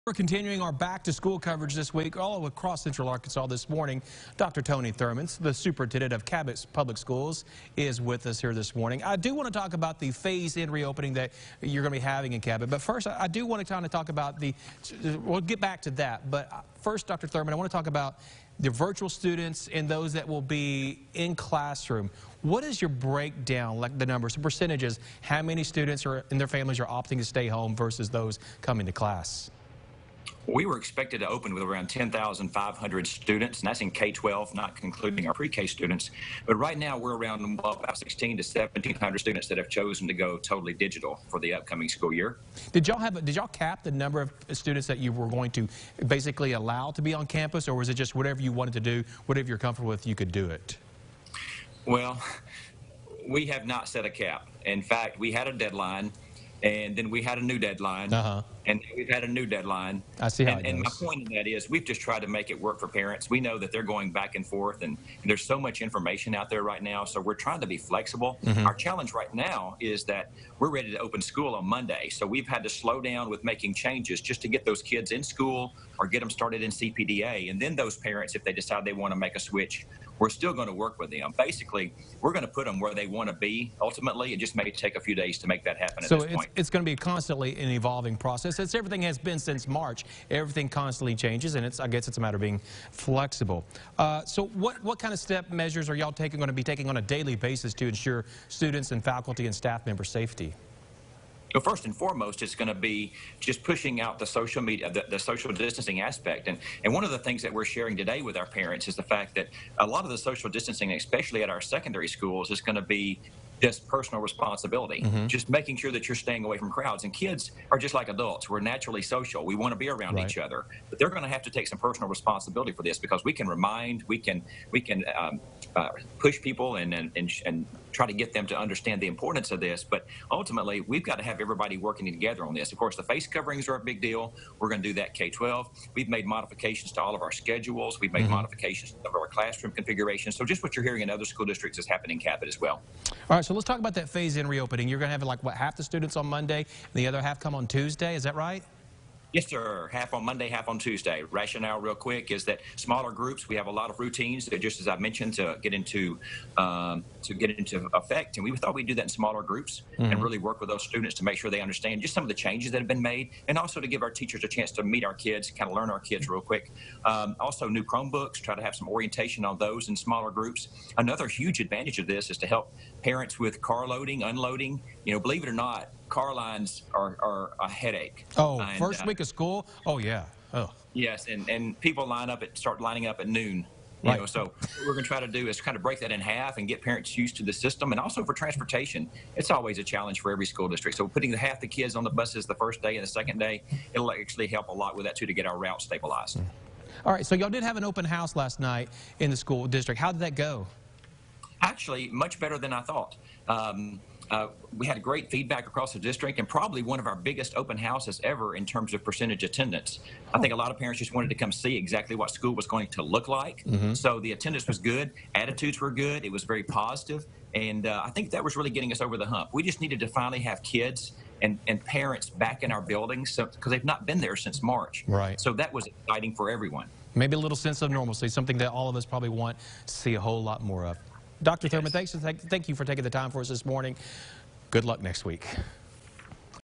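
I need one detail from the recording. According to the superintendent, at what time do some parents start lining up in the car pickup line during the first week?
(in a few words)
noon.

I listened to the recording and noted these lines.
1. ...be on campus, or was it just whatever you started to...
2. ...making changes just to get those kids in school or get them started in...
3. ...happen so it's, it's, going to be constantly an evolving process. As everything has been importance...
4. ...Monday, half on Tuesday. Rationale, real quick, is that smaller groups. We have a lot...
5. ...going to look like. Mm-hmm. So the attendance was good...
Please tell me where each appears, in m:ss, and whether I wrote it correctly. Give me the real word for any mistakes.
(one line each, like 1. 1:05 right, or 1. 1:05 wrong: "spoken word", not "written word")
1. 0:47 wrong: "wanted", not "started"
2. 1:13 right
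3. 1:25 wrong: "since", not "importance"
4. 2:30 right
5. 3:32 right.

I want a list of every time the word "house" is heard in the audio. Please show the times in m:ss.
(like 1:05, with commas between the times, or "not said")
3:18, 3:27.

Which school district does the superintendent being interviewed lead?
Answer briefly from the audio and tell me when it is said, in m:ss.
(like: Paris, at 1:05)
Cabot Public Schools, at 0:06.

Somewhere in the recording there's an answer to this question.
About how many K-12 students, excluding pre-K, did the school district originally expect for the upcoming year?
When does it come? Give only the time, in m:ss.
0:31.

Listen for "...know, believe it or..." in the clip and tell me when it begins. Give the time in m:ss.
2:55.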